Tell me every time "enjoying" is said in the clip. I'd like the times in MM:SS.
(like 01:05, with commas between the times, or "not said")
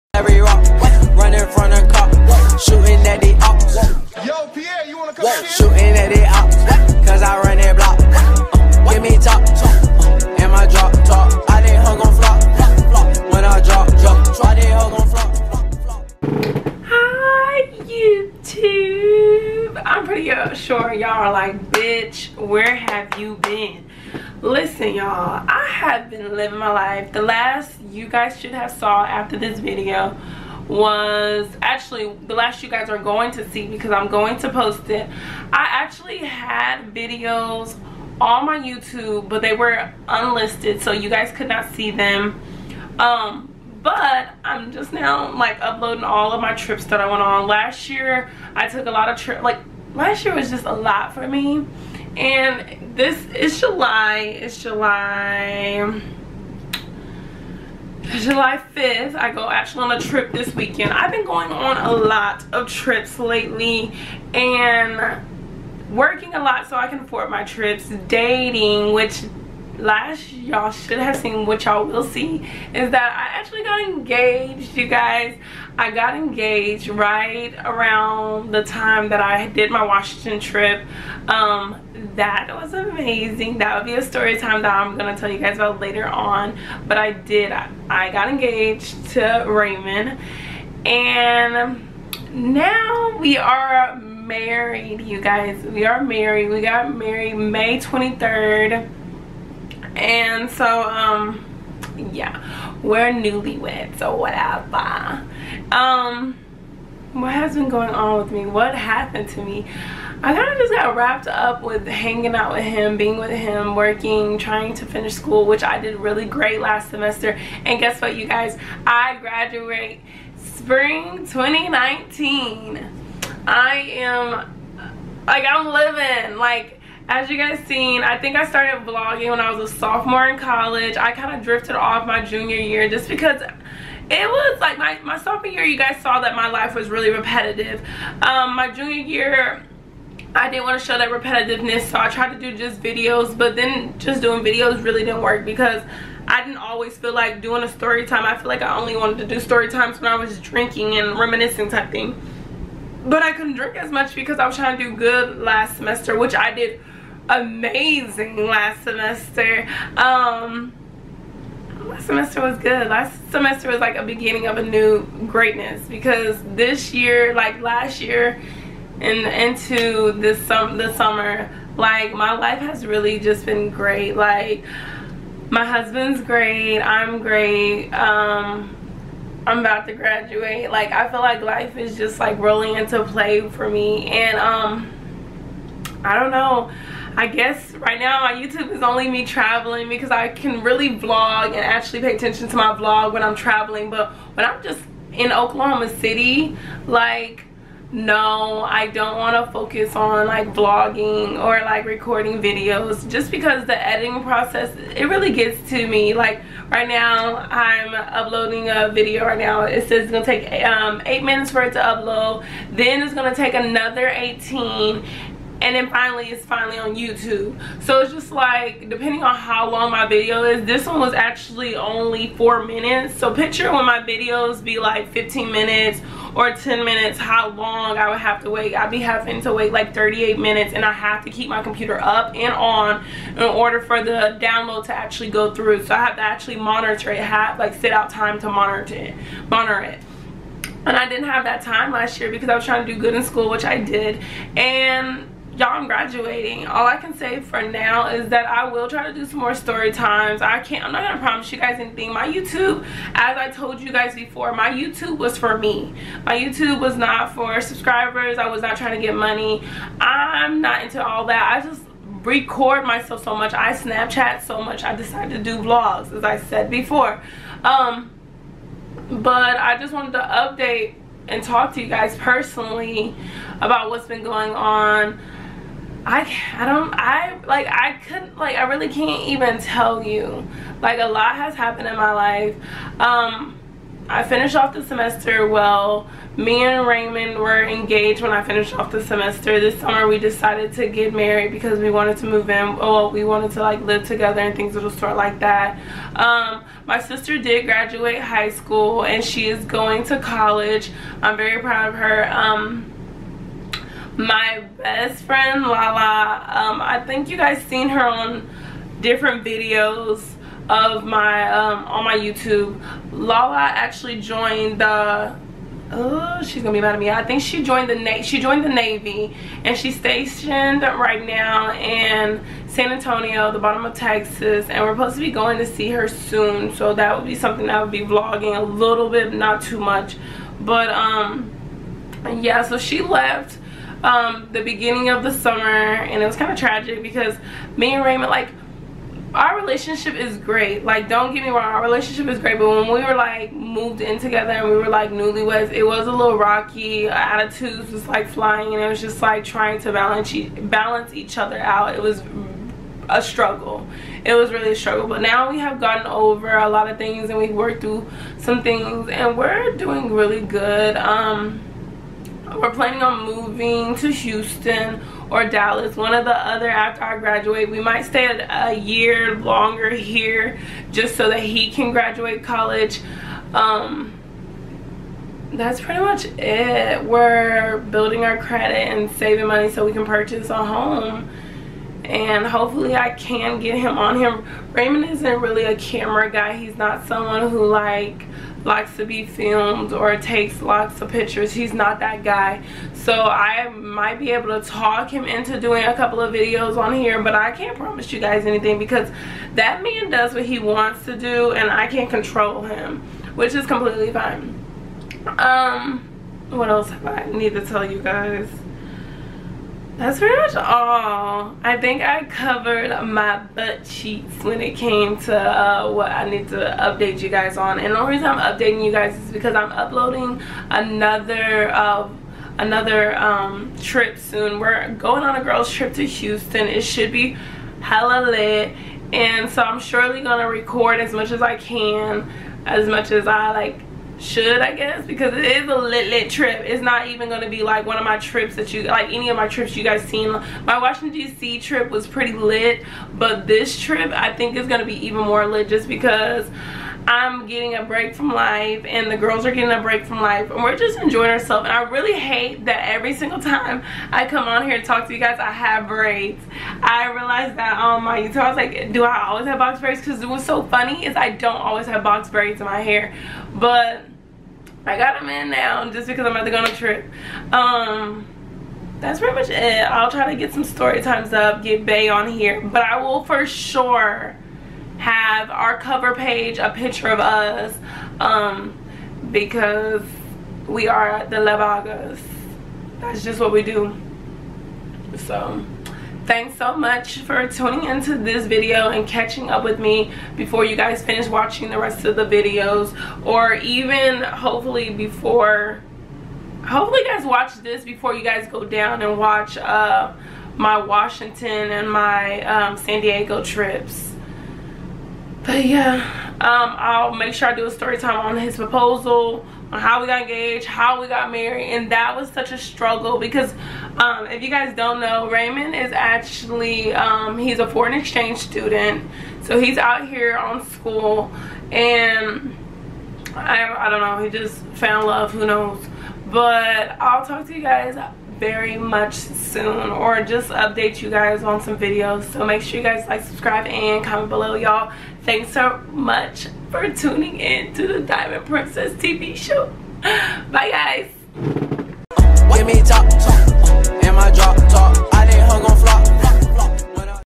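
07:30.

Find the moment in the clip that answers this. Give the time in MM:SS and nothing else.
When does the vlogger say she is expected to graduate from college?
02:00.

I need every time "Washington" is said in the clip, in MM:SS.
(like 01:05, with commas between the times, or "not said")
01:19, 07:20, 08:20.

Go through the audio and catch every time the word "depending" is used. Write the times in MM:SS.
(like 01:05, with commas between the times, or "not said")
03:38.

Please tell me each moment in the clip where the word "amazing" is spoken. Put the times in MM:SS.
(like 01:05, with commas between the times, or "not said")
01:22, 02:37.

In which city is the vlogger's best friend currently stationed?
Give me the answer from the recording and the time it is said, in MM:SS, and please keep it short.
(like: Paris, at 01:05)
San Antonio, at 05:22.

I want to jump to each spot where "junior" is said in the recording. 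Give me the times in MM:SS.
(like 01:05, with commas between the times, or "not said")
02:12, 02:18.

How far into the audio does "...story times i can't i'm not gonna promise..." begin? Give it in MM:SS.
04:09.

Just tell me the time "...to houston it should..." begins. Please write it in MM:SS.
07:05.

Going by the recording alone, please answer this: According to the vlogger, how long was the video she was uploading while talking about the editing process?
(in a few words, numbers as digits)
4 minutes.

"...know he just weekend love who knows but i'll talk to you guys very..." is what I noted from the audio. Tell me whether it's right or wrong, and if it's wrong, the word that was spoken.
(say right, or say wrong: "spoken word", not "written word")
wrong: "found", not "weekend".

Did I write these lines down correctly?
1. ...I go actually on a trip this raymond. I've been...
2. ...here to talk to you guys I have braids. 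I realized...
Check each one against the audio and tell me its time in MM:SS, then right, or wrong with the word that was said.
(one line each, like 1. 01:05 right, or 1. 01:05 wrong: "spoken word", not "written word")
1. 00:59 wrong: "weekend", not "raymond"
2. 07:34 right.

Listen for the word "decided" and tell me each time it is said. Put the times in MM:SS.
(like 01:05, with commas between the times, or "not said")
04:24, 04:50.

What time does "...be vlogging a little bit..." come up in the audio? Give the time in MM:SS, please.
05:27.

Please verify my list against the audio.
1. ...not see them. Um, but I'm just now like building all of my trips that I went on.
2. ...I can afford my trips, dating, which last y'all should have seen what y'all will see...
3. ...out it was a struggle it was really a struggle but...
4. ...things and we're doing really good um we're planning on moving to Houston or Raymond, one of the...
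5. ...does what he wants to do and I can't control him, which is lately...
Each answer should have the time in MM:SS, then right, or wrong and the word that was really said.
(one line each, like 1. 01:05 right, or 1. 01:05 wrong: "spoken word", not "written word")
1. 00:41 wrong: "uploading", not "building"
2. 01:06 right
3. 05:51 right
4. 05:58 wrong: "Dallas", not "Raymond"
5. 06:40 wrong: "completely", not "lately".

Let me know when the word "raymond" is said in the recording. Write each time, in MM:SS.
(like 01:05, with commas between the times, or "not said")
01:29, 04:46, 05:38, 06:24, 08:35.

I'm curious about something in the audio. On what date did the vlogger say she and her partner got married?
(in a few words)
May 23.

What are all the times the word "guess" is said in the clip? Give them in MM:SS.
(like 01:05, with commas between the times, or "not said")
01:57, 03:07, 07:14.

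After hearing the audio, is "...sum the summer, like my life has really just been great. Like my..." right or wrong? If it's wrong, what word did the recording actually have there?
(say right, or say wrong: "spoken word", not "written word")
right.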